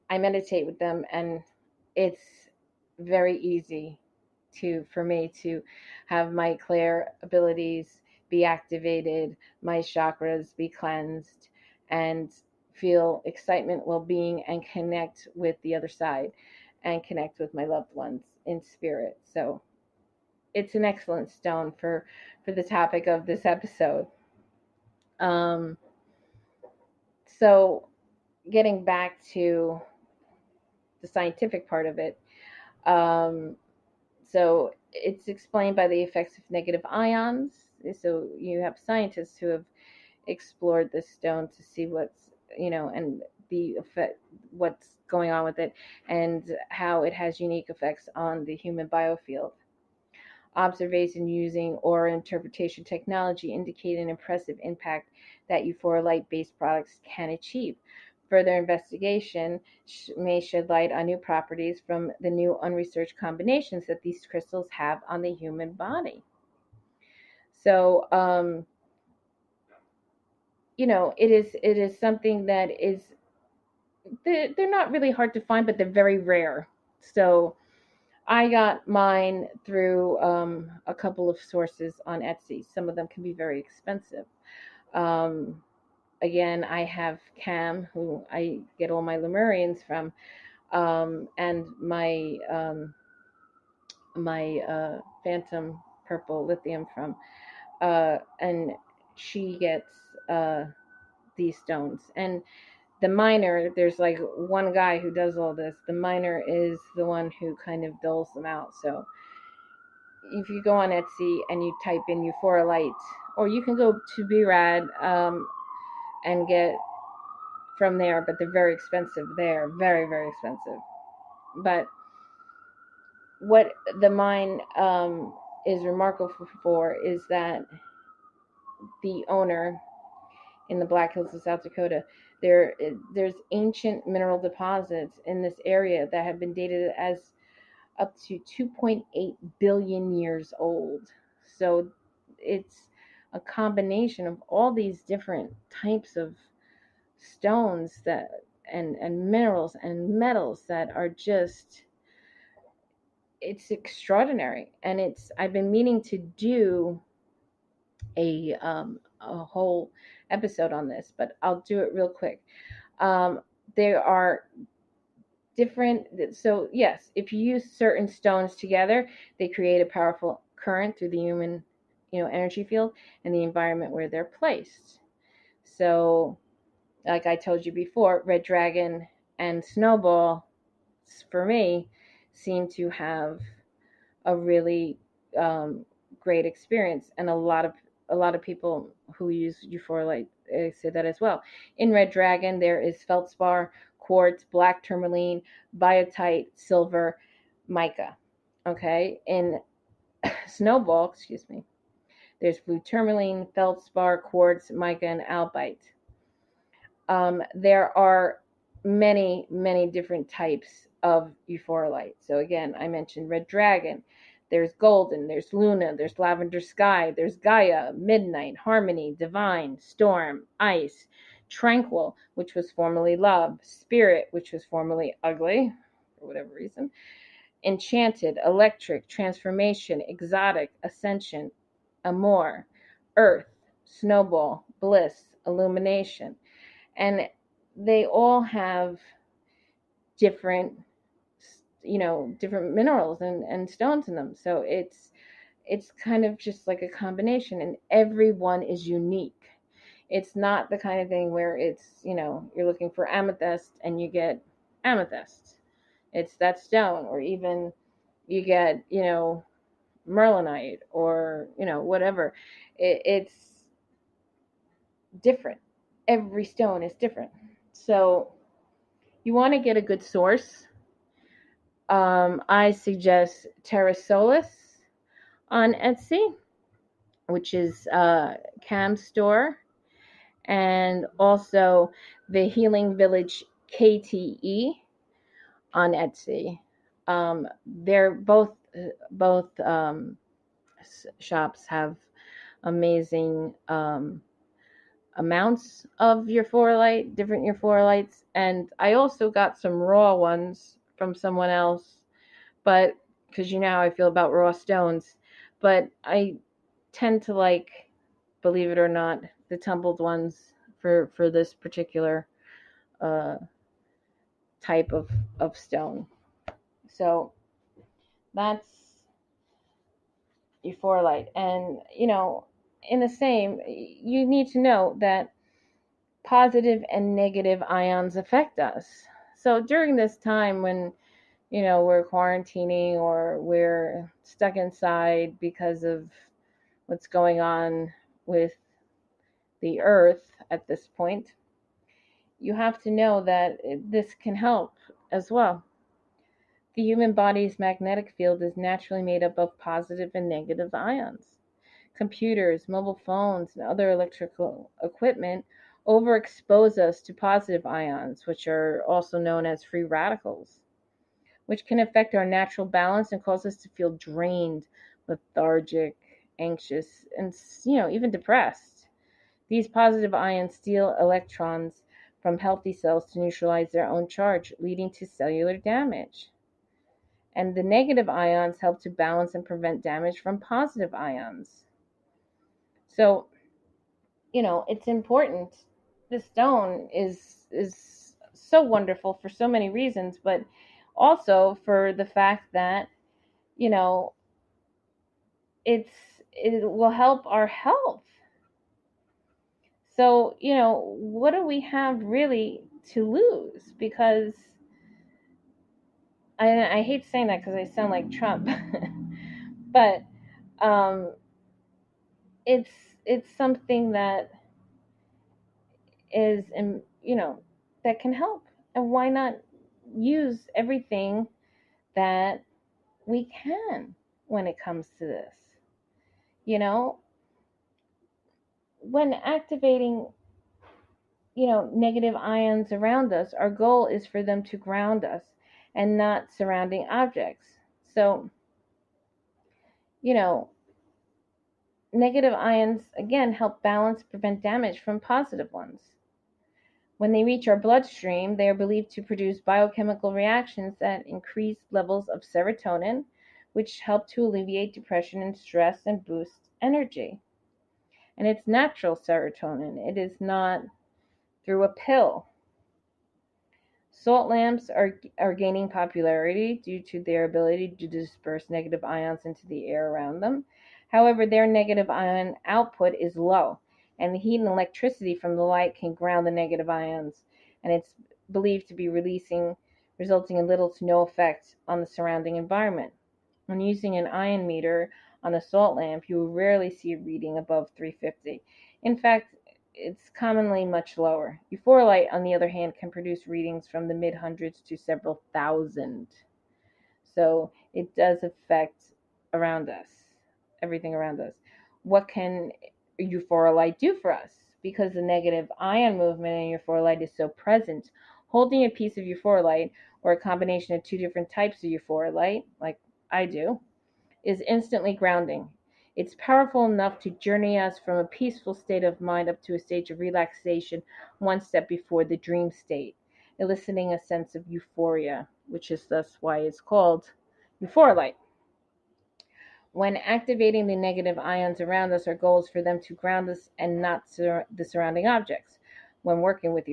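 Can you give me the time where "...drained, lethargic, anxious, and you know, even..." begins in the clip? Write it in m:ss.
6:03.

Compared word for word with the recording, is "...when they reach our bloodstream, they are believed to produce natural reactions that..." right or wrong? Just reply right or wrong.
wrong.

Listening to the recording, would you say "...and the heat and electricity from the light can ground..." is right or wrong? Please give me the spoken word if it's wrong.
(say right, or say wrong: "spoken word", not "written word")
right.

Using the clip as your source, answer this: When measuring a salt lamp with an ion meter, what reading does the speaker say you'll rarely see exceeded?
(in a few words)
350.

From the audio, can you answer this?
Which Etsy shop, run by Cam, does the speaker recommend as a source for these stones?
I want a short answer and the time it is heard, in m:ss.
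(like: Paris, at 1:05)
Terra Solis, at 4:33.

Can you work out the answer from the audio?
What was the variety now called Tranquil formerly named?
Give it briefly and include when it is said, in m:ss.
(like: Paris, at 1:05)
Love, at 3:43.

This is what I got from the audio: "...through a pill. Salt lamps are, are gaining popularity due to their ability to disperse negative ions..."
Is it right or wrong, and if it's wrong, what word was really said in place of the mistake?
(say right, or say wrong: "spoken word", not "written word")
right.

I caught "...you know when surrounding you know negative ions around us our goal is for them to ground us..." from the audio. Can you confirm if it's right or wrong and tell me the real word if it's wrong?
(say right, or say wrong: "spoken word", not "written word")
wrong: "activating", not "surrounding".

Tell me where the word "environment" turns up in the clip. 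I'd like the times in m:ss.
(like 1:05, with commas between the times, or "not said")
2:53, 8:02.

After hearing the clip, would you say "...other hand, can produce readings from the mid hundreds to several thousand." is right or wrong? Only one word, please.
right.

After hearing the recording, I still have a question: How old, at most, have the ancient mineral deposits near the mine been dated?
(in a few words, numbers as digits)
2.8 billion years.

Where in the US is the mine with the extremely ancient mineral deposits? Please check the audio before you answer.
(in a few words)
Black Hills of South Dakota.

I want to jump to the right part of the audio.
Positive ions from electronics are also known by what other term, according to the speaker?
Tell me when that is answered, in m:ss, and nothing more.
5:59.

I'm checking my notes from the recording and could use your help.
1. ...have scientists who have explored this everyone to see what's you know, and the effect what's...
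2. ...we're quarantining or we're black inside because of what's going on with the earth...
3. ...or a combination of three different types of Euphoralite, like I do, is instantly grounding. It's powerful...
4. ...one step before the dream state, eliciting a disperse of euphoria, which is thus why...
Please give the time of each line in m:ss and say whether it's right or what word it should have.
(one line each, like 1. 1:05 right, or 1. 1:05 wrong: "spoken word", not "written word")
1. 0:38 wrong: "stone", not "everyone"
2. 5:31 wrong: "stuck", not "black"
3. 8:30 wrong: "two", not "three"
4. 8:41 wrong: "sense", not "disperse".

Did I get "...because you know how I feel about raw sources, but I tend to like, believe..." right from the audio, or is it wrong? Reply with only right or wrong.
wrong.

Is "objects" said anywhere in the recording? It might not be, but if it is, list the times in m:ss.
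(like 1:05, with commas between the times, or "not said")
7:16, 8:55.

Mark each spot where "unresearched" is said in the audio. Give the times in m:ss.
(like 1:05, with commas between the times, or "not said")
1:02.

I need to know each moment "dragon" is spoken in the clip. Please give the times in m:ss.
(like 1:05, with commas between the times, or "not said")
2:58, 3:12, 3:33.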